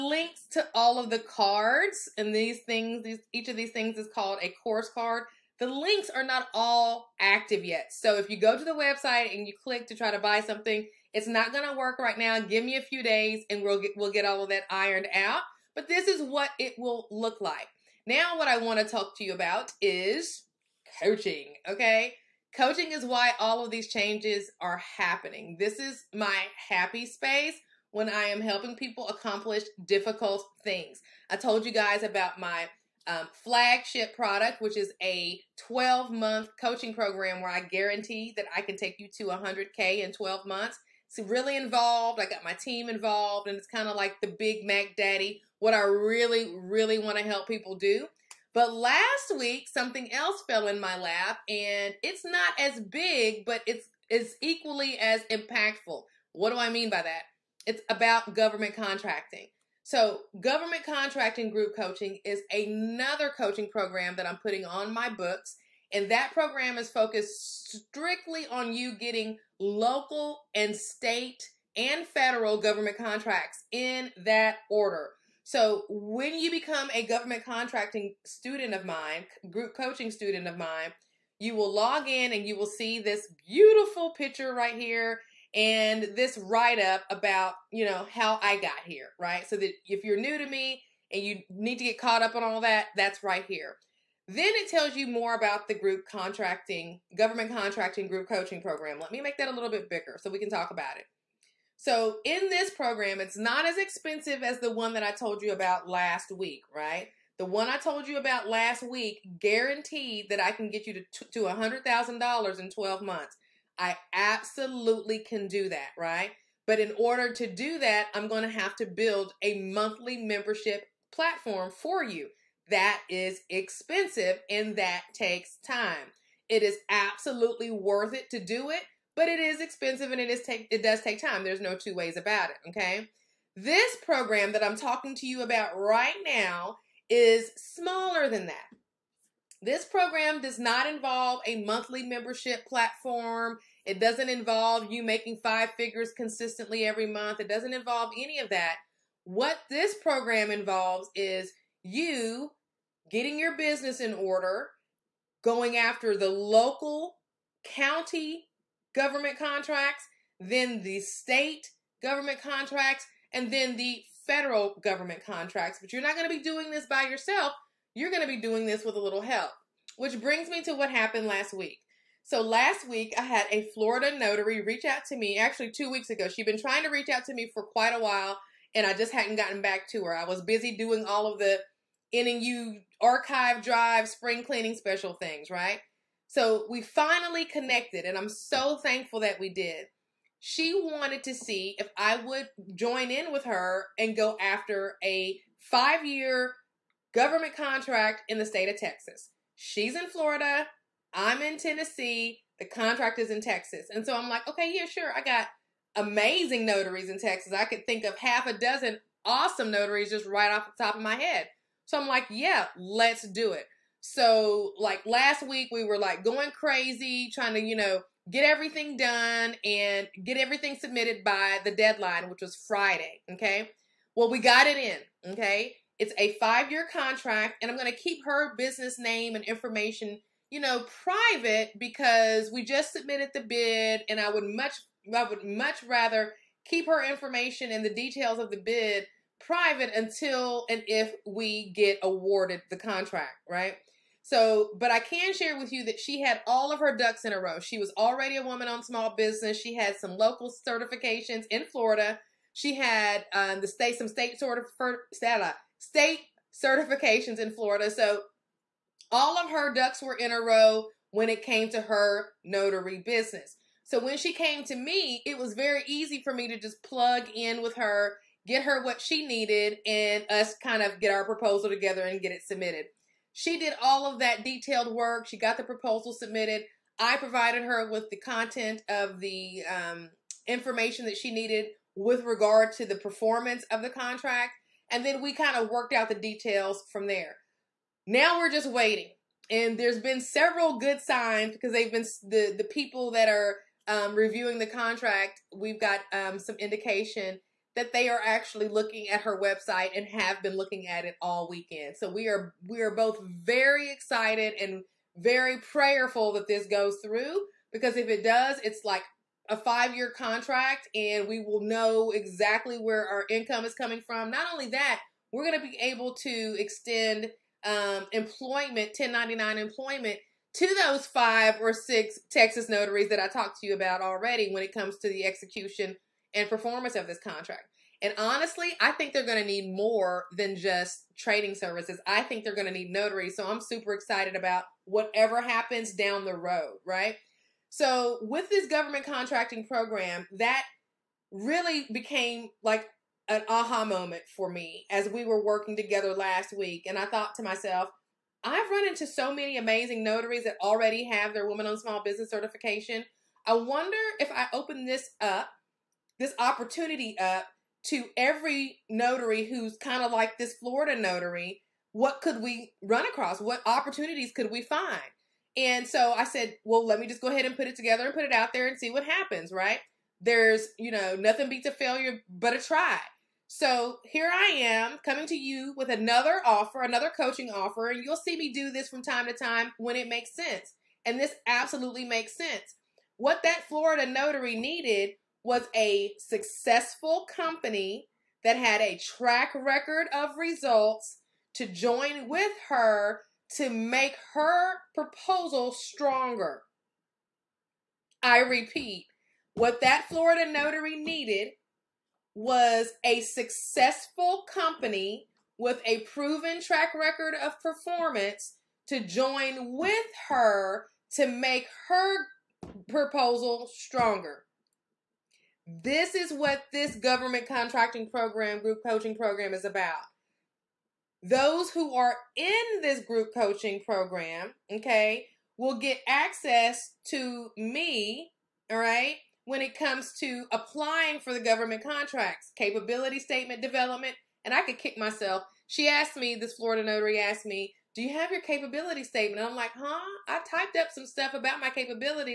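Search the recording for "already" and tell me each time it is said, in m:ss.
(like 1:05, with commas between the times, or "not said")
4:07, 5:23, 5:50.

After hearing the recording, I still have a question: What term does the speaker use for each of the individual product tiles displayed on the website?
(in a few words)
Course card.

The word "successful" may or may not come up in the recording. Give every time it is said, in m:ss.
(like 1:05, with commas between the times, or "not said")
6:26, 6:43.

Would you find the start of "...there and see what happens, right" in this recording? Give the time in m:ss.
6:08.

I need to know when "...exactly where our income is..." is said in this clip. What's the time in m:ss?
5:12.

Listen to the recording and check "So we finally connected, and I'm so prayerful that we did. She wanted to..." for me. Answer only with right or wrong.
wrong.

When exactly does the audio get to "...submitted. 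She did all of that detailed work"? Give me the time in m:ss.
4:32.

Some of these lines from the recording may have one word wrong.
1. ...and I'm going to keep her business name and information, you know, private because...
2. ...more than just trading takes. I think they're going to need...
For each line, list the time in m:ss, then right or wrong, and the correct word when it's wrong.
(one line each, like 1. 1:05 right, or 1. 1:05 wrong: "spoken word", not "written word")
1. 3:47 right
2. 5:29 wrong: "services", not "takes".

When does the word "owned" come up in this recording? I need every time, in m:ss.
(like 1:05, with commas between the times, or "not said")
4:08, 5:51.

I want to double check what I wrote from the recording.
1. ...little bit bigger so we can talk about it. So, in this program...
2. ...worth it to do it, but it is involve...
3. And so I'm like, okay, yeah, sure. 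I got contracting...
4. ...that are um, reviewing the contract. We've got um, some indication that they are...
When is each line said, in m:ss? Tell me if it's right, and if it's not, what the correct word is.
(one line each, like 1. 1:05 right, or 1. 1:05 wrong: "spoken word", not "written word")
1. 1:39 right
2. 2:07 wrong: "expensive", not "involve"
3. 3:23 wrong: "amazing", not "contracting"
4. 4:53 right.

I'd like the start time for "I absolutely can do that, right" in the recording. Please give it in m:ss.
1:53.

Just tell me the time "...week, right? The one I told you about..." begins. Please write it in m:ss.
1:46.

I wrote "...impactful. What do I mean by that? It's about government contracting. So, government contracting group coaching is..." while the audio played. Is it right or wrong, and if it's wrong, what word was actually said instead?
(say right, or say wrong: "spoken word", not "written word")
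right.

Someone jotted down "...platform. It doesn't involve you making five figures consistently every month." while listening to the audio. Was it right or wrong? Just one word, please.
right.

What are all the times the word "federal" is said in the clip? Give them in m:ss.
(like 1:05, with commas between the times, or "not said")
1:12, 2:44.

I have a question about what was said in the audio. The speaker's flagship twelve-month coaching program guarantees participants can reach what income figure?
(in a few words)
$100K.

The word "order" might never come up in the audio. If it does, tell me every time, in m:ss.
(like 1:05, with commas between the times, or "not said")
1:14, 1:56, 2:34.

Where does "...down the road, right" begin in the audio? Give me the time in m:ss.
5:35.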